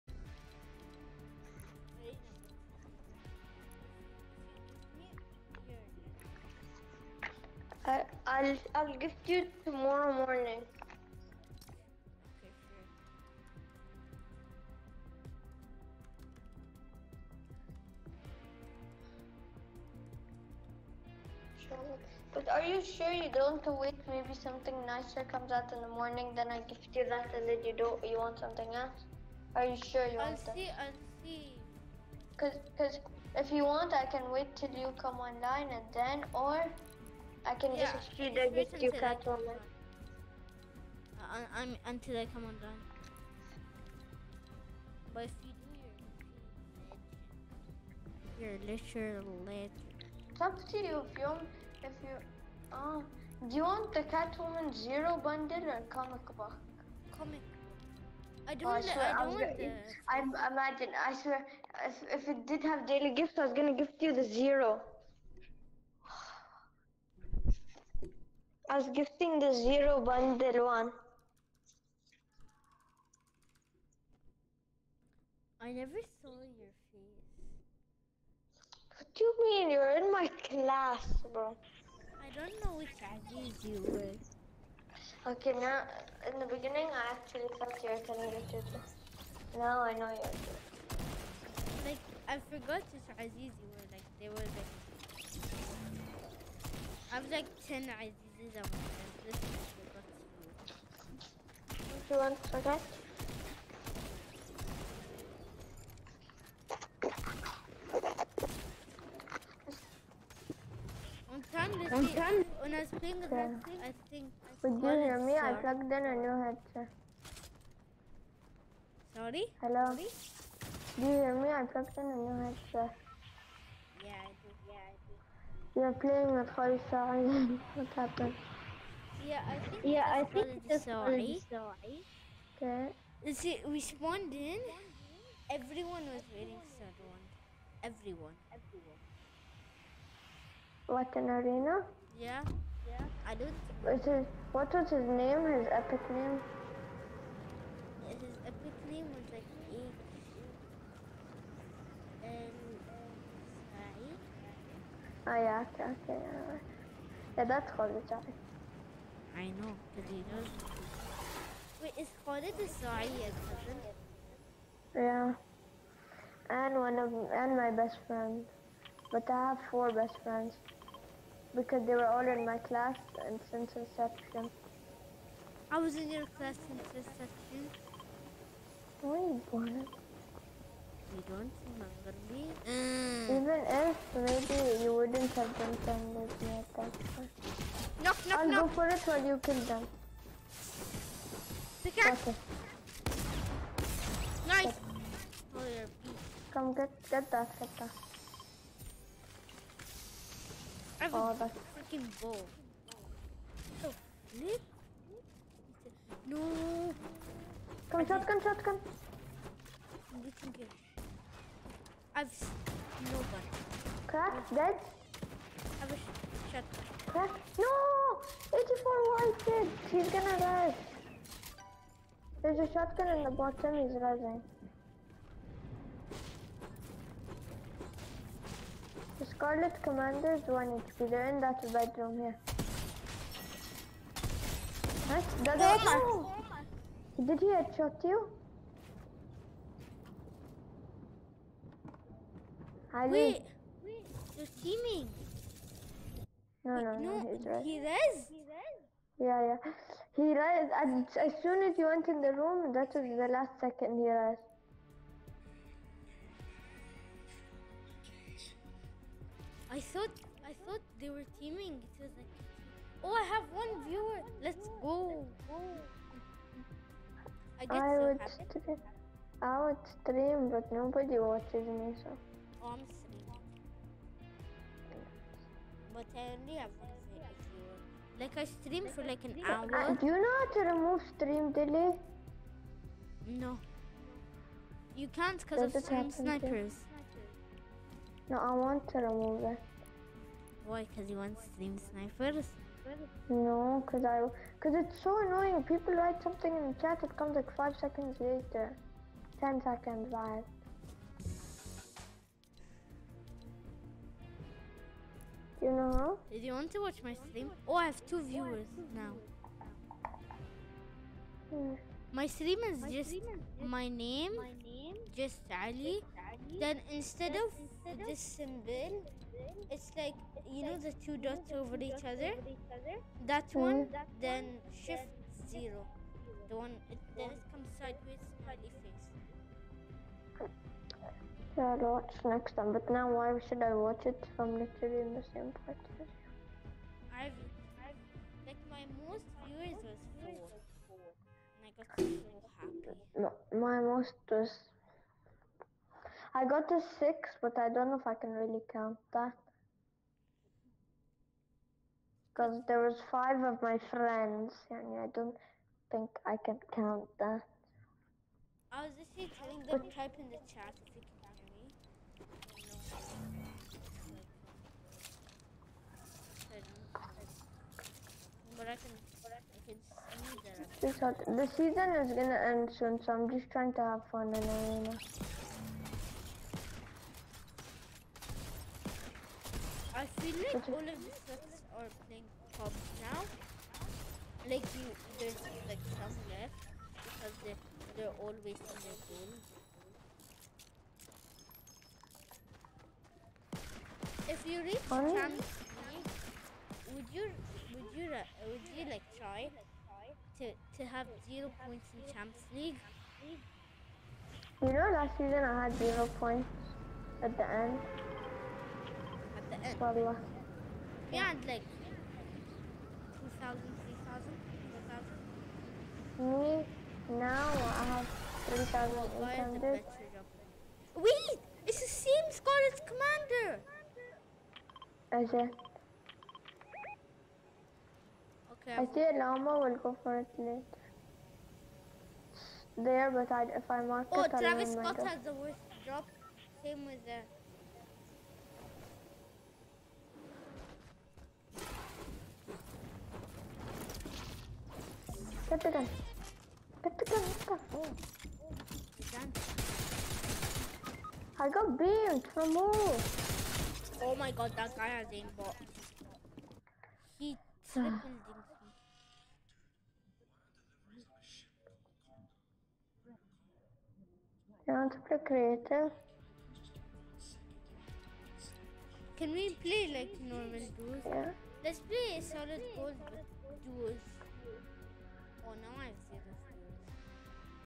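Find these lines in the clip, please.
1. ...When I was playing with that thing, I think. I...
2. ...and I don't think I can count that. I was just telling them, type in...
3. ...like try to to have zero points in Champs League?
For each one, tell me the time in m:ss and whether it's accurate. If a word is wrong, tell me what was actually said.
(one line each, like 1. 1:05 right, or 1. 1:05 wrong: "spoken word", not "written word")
1. 1:52 right
2. 5:54 right
3. 6:38 right.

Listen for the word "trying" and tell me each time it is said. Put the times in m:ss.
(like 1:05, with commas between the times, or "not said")
6:13.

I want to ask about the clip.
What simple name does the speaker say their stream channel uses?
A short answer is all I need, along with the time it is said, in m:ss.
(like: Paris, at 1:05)
Ali, at 5:15.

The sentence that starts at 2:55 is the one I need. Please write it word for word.
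I was in your class since inception.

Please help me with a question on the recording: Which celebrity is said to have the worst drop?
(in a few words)
Travis Scott.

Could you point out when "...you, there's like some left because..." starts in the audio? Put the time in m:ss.
6:24.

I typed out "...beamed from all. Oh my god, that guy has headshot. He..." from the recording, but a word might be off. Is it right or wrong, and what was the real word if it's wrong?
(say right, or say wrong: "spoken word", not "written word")
wrong: "aimbot", not "headshot".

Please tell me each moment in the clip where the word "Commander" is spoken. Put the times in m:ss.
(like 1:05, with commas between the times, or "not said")
3:49, 7:02.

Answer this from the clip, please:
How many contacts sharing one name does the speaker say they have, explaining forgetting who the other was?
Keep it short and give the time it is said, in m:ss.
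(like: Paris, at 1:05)
10, at 1:37.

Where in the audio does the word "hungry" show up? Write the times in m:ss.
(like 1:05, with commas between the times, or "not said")
3:02.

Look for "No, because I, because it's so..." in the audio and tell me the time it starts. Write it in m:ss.
4:53.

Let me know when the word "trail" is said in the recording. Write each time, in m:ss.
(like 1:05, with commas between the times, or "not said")
not said.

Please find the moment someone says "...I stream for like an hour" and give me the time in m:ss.
4:38.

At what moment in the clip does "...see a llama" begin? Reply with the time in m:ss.
7:08.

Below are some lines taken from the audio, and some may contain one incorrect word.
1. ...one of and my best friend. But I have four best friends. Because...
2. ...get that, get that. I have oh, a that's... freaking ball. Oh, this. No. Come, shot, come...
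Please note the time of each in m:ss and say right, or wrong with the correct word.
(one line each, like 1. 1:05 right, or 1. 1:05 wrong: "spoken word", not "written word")
1. 2:46 right
2. 3:17 right.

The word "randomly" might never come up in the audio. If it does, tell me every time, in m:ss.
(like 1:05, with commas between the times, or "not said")
not said.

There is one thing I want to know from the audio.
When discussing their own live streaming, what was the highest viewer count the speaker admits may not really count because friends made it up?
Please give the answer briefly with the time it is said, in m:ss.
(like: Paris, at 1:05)
6, at 5:46.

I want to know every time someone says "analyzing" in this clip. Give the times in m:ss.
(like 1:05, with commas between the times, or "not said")
not said.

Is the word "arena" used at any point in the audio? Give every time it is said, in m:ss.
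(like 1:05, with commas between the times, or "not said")
2:21, 6:14.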